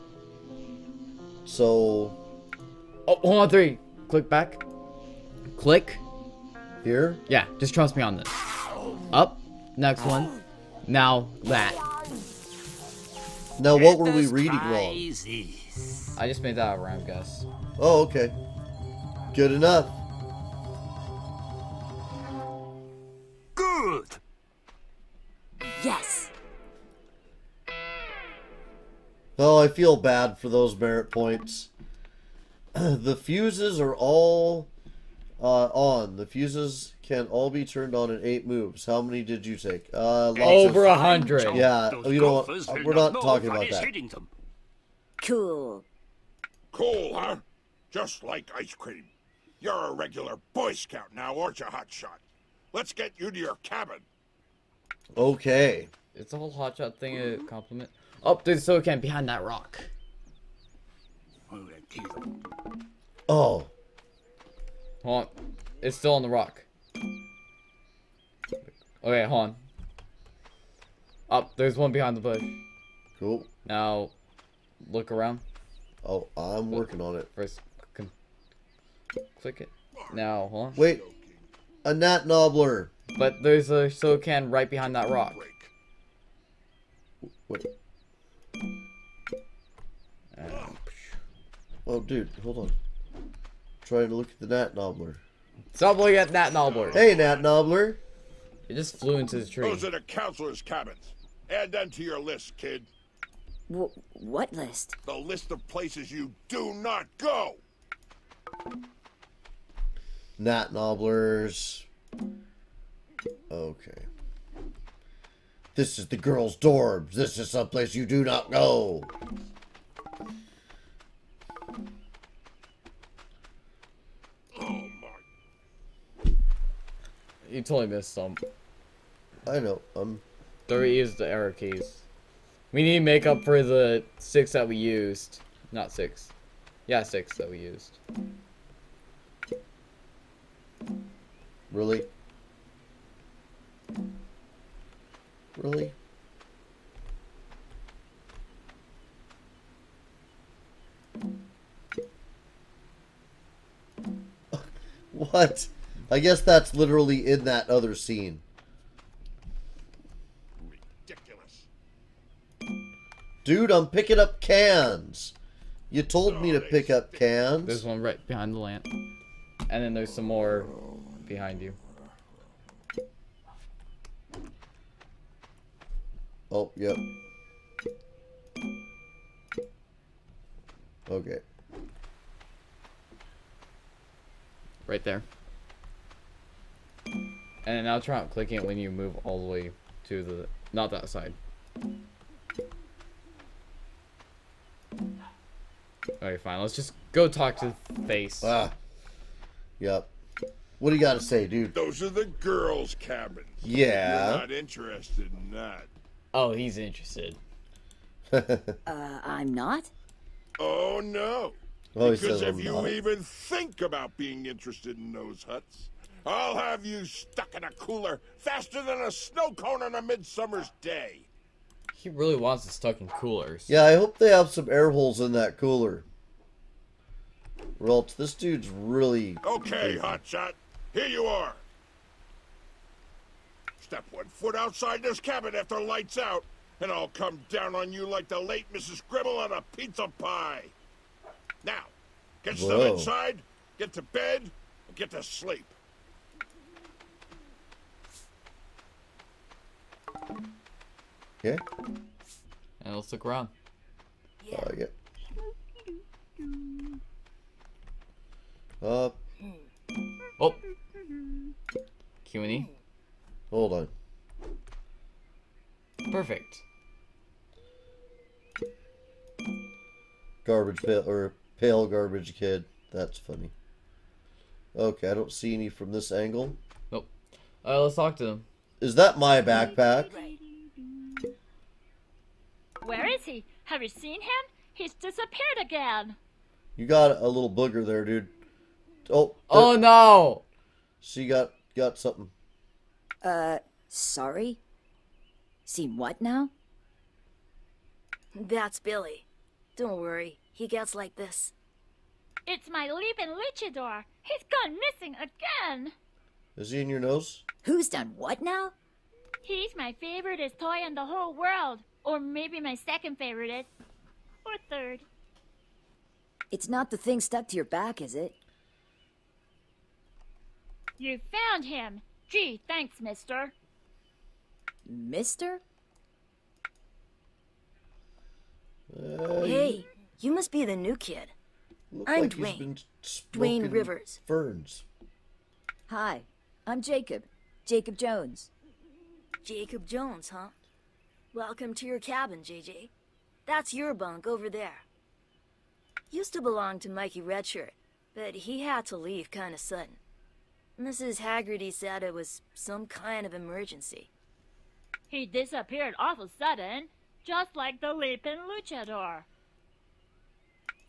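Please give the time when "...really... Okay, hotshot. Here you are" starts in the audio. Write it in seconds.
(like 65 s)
228 s.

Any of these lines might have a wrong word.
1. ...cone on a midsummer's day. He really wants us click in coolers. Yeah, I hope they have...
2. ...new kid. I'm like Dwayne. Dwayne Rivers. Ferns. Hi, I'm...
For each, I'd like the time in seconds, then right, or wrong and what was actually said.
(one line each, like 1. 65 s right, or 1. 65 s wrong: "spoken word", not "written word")
1. 219 s wrong: "stuck", not "click"
2. 330 s right.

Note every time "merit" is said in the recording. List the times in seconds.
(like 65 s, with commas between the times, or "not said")
30 s.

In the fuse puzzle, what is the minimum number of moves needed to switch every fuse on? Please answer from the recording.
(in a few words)
8.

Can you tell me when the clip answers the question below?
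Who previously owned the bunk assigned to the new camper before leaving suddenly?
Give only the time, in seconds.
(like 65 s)
346 s.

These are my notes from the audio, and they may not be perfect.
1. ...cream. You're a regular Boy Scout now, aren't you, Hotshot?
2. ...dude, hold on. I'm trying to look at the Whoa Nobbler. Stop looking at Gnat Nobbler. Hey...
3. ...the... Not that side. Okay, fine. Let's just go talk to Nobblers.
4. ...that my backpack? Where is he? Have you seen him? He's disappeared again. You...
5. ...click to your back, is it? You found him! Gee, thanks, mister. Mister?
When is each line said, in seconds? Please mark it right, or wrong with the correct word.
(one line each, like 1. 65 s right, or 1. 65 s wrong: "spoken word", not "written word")
1. 48 s right
2. 91 s wrong: "Gnat", not "Whoa"
3. 190 s wrong: "Face", not "Nobblers"
4. 278 s right
5. 317 s wrong: "stuck", not "click".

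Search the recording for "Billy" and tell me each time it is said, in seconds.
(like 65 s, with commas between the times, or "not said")
298 s.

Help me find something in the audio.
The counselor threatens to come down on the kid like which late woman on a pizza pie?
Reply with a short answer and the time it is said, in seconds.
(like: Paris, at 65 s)
Mrs. Gribble, at 238 s.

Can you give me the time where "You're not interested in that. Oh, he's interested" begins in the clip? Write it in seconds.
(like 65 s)
204 s.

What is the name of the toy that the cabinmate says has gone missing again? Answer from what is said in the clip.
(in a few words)
leaping luchador.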